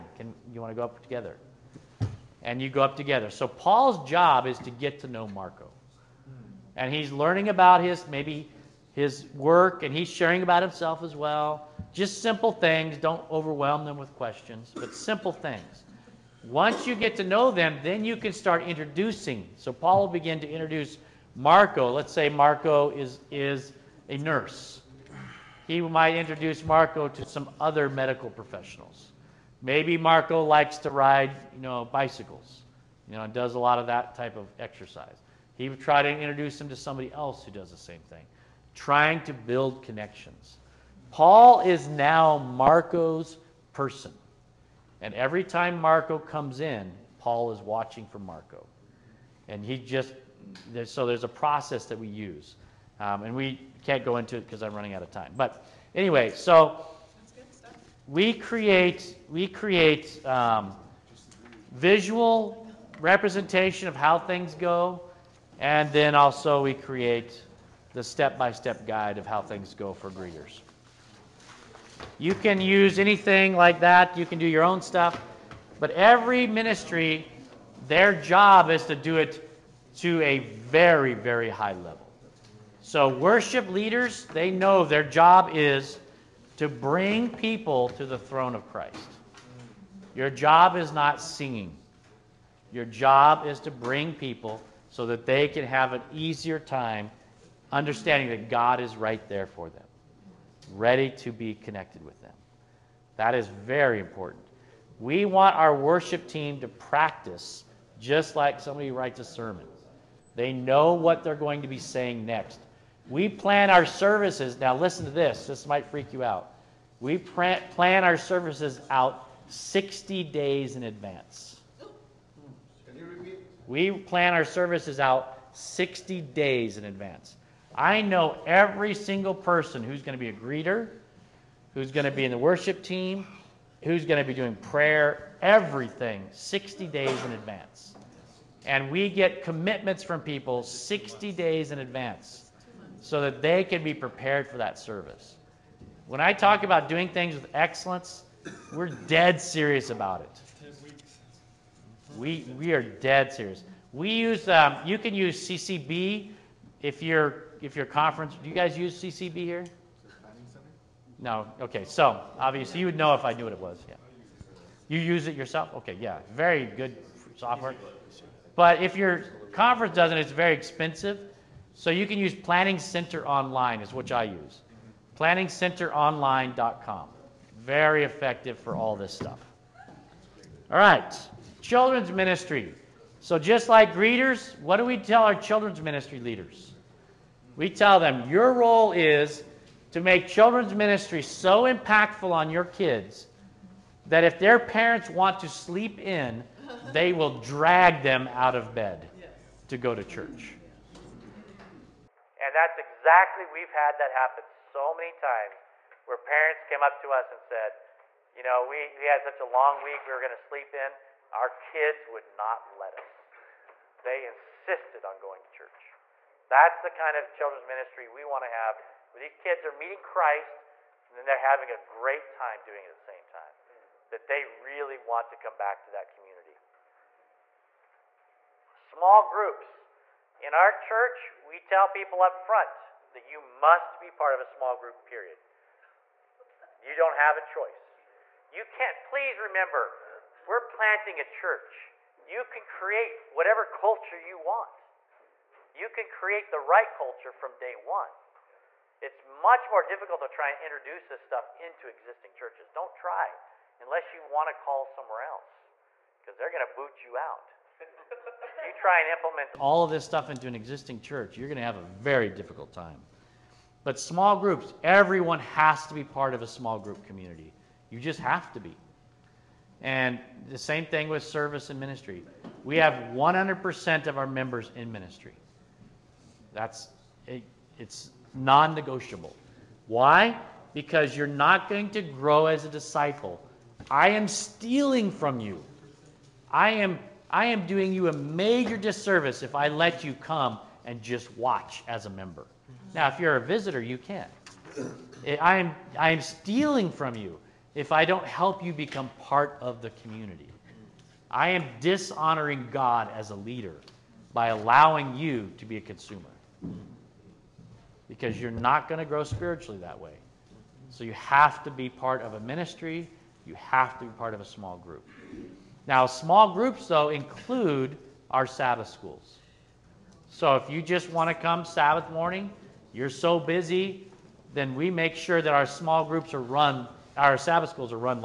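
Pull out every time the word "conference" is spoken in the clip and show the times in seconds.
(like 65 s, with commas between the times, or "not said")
157 s, 169 s.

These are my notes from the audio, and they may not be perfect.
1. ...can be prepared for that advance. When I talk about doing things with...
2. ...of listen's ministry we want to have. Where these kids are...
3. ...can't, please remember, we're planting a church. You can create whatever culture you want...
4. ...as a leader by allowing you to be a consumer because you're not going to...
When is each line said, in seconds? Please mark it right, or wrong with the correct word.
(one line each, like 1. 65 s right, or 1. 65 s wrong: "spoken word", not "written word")
1. 143 s wrong: "service", not "advance"
2. 217 s wrong: "children", not "listen"
3. 238 s right
4. 303 s right.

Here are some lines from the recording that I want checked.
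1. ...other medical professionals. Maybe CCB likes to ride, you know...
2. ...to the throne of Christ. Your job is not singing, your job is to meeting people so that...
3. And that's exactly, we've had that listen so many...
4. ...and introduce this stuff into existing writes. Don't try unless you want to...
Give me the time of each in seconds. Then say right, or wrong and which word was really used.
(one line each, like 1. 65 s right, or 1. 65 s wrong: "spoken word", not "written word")
1. 27 s wrong: "Marco", not "CCB"
2. 87 s wrong: "bring", not "meeting"
3. 202 s wrong: "happen", not "listen"
4. 250 s wrong: "churches", not "writes".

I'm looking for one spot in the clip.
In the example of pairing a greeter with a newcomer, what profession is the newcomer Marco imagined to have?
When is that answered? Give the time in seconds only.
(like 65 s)
24 s.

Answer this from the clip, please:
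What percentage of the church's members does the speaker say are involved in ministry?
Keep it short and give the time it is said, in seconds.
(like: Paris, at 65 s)
100%, at 273 s.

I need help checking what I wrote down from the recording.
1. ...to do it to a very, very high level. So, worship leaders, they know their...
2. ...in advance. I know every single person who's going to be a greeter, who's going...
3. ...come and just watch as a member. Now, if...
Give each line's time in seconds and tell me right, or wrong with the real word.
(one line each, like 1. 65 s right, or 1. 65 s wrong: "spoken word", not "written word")
1. 78 s right
2. 126 s right
3. 290 s right.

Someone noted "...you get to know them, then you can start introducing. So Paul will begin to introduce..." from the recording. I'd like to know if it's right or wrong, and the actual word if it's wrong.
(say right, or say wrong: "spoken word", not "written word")
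right.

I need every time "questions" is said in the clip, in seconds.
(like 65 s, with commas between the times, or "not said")
14 s.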